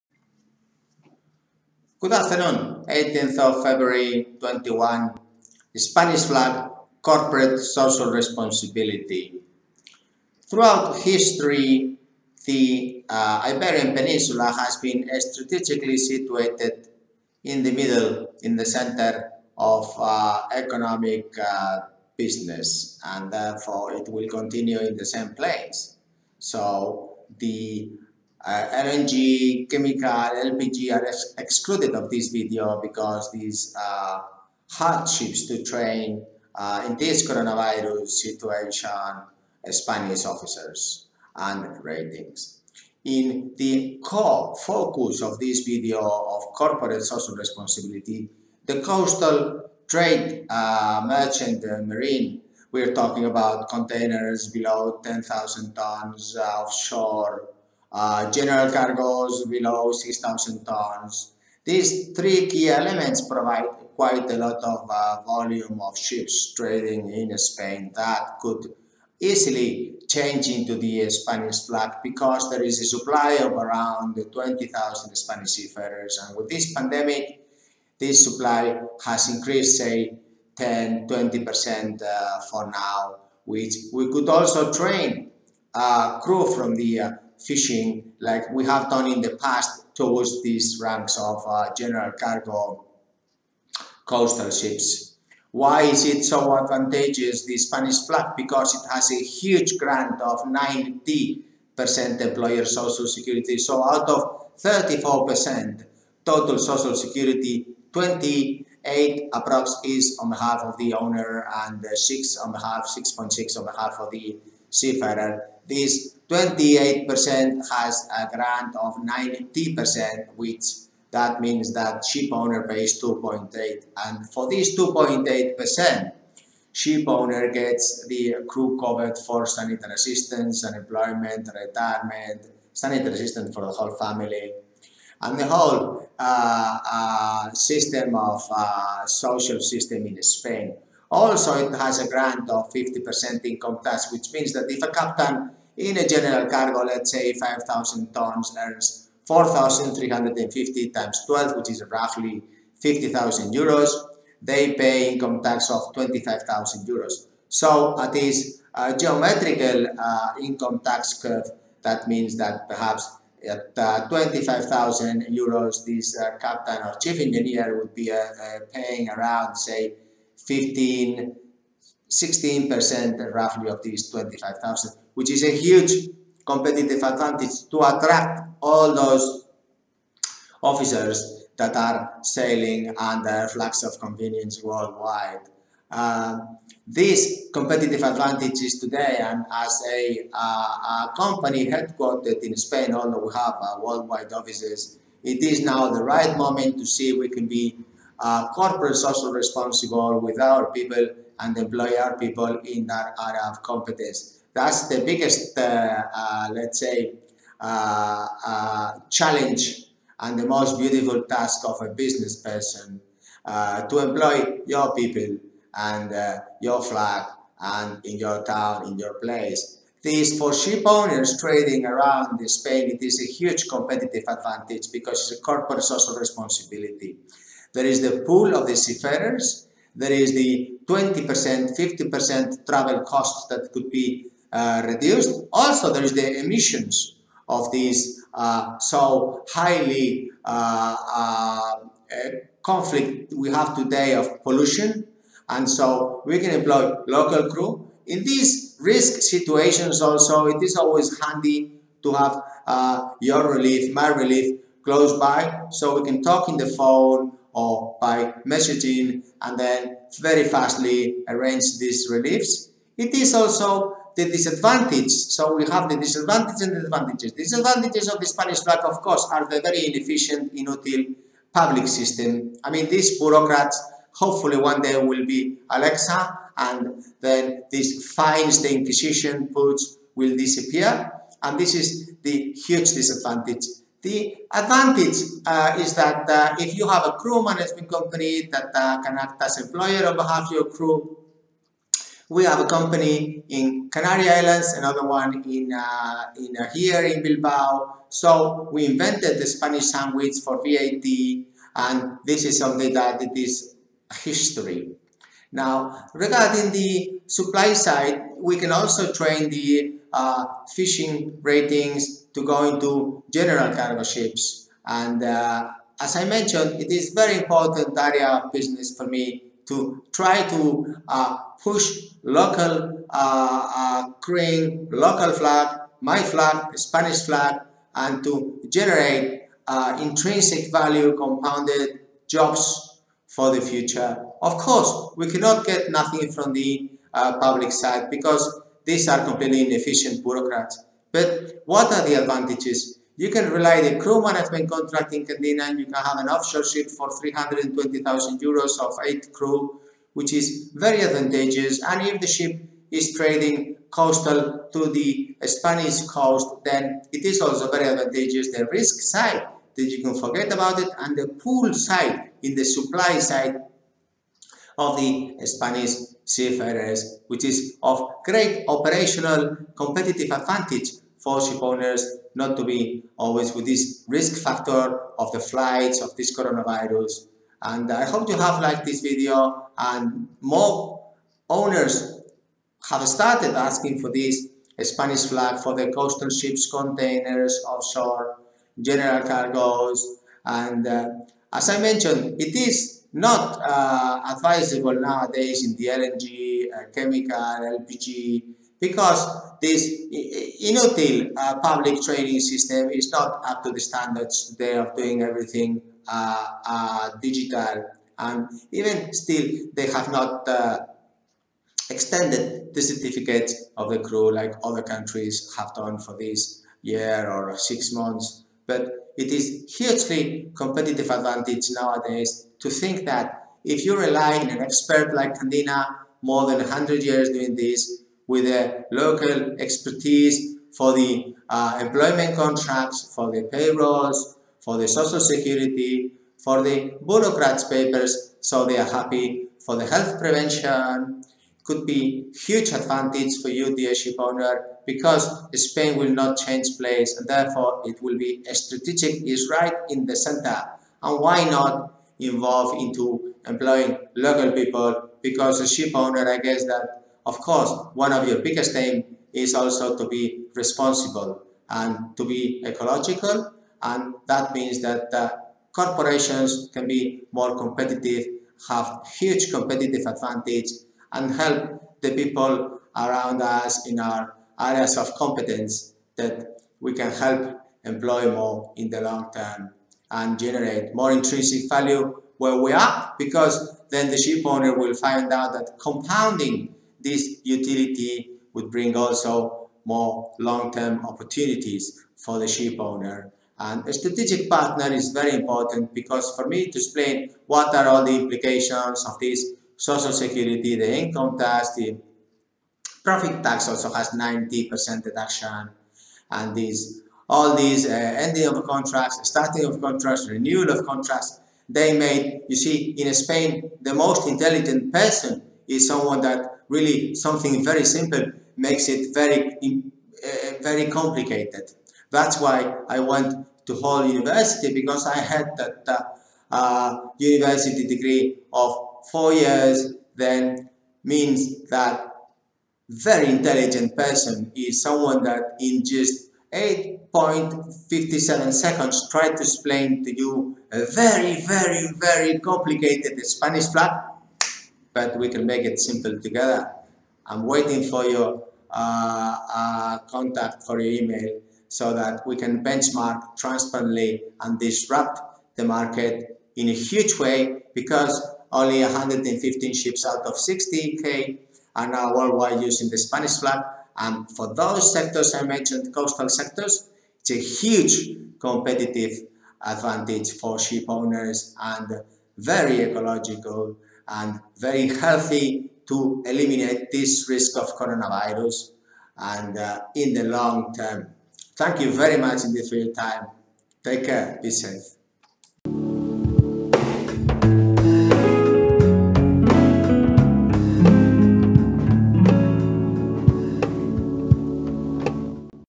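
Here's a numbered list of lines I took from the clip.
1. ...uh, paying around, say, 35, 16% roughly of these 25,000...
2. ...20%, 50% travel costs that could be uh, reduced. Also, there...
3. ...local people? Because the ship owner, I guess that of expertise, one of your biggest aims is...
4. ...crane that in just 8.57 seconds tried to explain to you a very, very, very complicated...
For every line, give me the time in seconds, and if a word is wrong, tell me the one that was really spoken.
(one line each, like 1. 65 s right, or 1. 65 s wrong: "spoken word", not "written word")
1. 168 s wrong: "15", not "35"
2. 230 s right
3. 454 s wrong: "course", not "expertise"
4. 534 s wrong: "someone", not "crane".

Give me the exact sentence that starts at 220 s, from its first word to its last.
This for ship owners trading around Spain, it is a huge competitive advantage because it's a corporate social responsibility.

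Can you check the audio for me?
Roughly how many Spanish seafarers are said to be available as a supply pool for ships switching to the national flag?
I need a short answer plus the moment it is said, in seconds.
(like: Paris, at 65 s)
20,000, at 74 s.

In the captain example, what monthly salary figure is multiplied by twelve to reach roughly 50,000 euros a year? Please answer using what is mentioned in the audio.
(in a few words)
4,350.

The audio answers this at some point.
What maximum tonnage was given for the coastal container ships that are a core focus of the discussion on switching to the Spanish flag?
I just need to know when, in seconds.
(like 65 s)
55 s.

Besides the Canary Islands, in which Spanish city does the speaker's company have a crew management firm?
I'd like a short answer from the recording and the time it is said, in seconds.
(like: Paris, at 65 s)
Bilbao, at 297 s.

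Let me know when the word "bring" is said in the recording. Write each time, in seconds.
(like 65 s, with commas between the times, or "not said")
488 s.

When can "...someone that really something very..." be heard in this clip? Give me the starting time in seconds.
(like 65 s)
515 s.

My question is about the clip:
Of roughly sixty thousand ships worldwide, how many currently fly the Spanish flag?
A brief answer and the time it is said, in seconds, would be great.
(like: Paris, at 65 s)
115, at 558 s.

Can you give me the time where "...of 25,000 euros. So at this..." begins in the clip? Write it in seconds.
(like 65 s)
155 s.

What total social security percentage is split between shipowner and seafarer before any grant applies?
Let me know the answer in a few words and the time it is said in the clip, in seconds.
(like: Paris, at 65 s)
34%, at 104 s.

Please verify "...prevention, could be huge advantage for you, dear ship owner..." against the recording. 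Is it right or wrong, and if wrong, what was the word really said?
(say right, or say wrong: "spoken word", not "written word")
right.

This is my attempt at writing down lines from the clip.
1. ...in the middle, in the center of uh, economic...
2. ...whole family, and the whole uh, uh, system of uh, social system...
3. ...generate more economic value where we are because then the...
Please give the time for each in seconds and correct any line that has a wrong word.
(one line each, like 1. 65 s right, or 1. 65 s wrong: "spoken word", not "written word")
1. 17 s right
2. 133 s right
3. 480 s wrong: "intrinsic", not "economic".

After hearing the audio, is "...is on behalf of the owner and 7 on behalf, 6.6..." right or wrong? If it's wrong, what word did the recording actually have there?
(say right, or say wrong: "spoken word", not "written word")
wrong: "6", not "7".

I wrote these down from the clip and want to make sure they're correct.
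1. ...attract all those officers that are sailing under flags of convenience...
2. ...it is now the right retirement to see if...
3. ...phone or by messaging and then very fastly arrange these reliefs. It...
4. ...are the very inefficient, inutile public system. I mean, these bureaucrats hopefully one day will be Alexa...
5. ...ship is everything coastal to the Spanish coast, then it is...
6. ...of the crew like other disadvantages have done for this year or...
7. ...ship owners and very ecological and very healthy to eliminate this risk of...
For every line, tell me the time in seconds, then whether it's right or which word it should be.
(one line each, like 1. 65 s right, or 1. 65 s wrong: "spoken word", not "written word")
1. 177 s right
2. 195 s wrong: "moment", not "retirement"
3. 256 s right
4. 269 s right
5. 352 s wrong: "trading", not "everything"
6. 413 s wrong: "countries", not "disadvantages"
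7. 570 s right.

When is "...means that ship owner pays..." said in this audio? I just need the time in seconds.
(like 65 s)
121 s.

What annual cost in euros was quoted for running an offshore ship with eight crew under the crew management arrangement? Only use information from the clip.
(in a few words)
320,000 euros.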